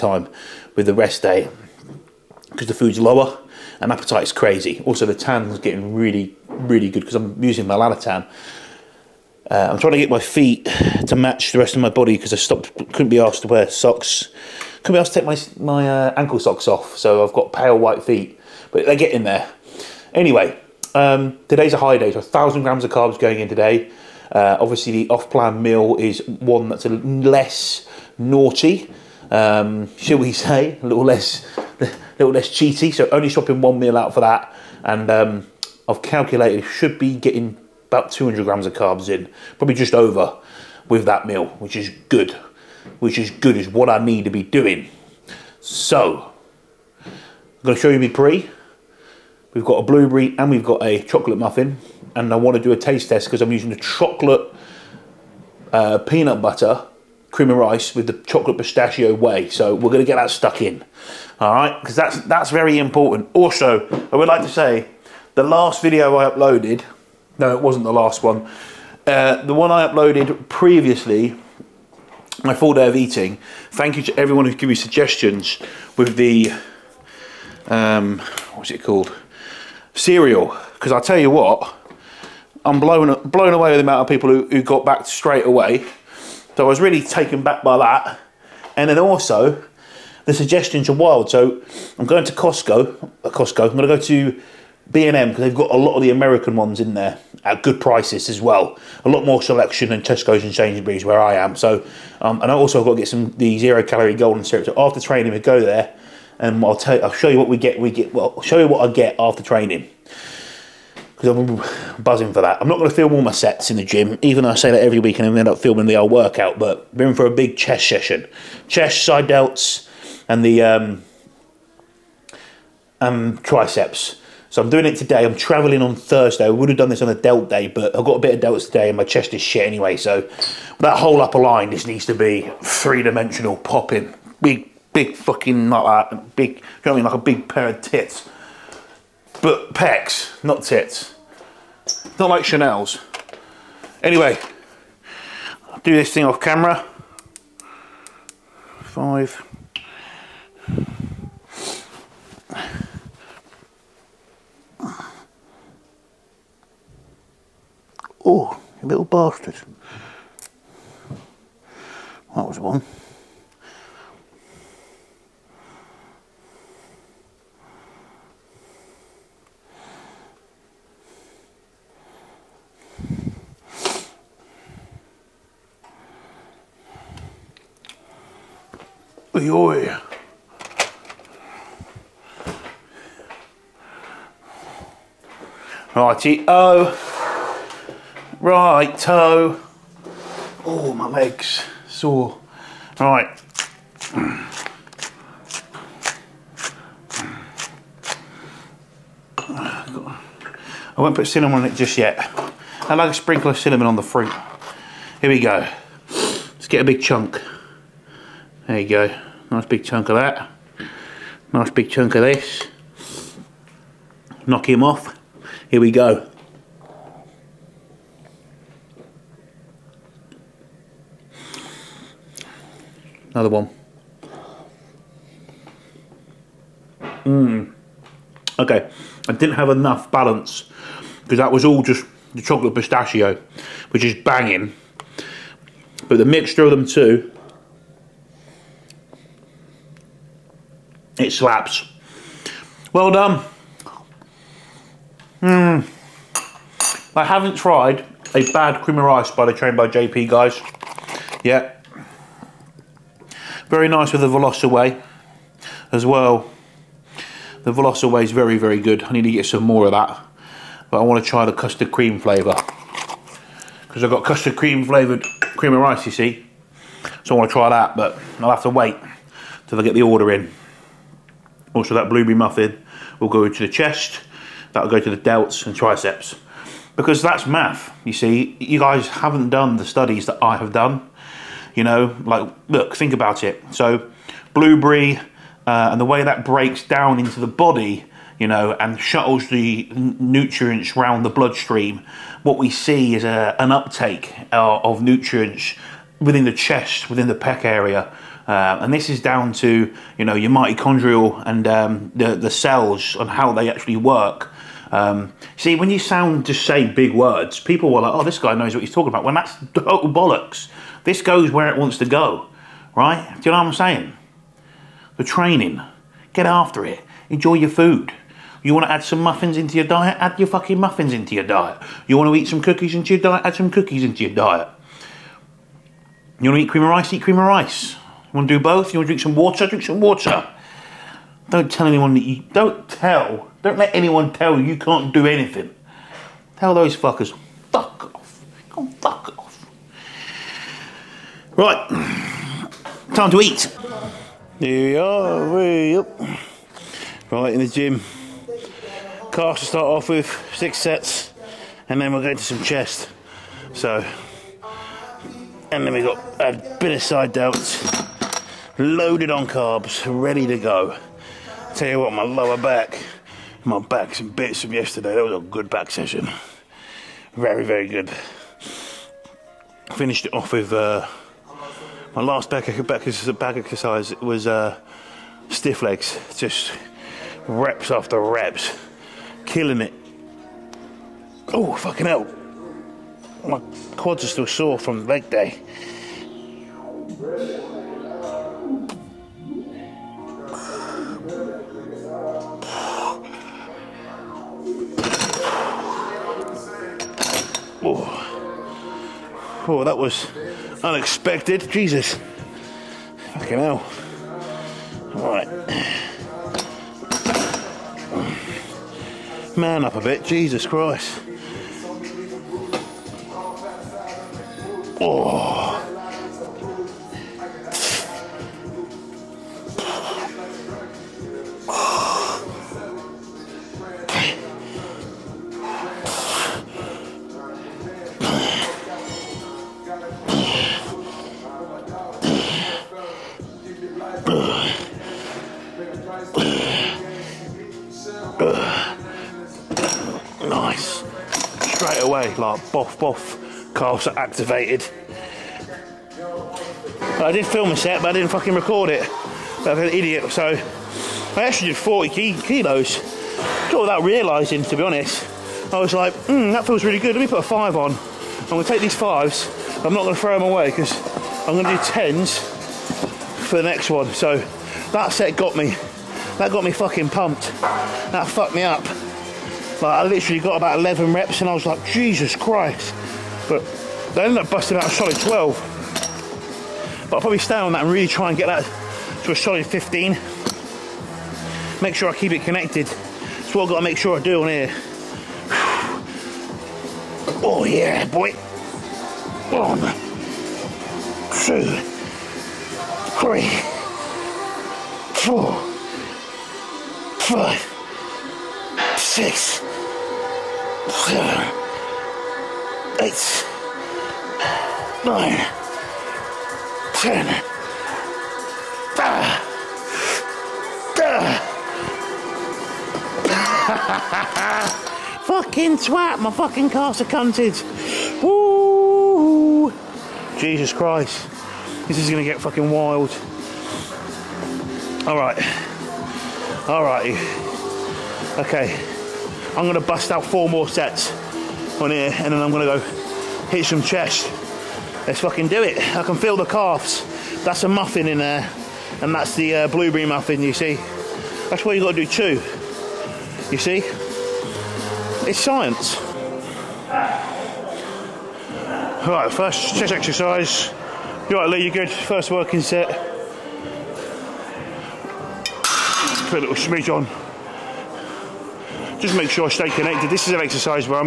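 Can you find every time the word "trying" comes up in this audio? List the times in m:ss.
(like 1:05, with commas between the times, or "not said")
0:09.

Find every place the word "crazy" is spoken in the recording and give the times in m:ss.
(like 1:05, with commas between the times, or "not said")
0:04.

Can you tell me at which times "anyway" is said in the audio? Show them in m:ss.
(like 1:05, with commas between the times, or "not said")
0:20, 2:09, 2:24.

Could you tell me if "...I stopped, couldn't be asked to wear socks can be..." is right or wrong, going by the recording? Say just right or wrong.
right.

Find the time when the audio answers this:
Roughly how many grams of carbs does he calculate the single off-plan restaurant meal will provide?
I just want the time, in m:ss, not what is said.
0:38.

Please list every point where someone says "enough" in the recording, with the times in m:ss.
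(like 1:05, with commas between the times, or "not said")
3:49.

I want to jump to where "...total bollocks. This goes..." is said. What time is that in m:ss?
5:09.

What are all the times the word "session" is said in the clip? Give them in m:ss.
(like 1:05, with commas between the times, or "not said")
1:57, 6:05.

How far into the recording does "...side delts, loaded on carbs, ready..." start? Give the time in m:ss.
5:57.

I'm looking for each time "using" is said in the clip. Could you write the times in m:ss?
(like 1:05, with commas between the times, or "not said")
0:07, 0:53.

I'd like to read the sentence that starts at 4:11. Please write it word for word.
Yeah, very nice with the whey, as well.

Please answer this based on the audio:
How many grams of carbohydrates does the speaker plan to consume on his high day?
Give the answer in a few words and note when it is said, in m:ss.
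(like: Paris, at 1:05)
1000, at 0:22.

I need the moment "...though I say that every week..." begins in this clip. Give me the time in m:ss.
1:54.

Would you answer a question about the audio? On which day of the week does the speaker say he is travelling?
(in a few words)
Thursday.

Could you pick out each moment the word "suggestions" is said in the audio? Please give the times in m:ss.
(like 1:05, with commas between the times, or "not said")
1:14, 1:30.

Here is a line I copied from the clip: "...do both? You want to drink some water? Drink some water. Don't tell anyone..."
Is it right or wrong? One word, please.
right.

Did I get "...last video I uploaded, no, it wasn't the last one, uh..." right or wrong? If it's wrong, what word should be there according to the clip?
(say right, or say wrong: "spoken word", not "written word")
right.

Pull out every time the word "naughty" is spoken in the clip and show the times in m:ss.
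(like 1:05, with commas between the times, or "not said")
0:28.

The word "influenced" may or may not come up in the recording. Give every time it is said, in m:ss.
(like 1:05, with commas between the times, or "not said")
not said.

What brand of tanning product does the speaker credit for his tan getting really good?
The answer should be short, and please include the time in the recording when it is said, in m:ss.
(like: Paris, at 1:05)
Lanatan, at 0:07.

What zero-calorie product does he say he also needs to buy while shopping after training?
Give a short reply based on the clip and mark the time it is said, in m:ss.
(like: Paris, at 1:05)
golden syrup, at 1:44.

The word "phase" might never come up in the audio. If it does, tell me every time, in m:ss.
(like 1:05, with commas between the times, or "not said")
not said.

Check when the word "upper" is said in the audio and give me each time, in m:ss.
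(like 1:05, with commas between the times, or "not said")
2:11.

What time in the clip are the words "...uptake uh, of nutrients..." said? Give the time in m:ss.
4:53.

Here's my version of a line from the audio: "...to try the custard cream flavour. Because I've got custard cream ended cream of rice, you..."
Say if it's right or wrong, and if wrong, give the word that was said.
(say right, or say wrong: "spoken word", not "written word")
wrong: "flavoured", not "ended".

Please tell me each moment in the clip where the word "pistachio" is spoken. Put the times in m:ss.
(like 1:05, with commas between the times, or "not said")
0:58, 3:52.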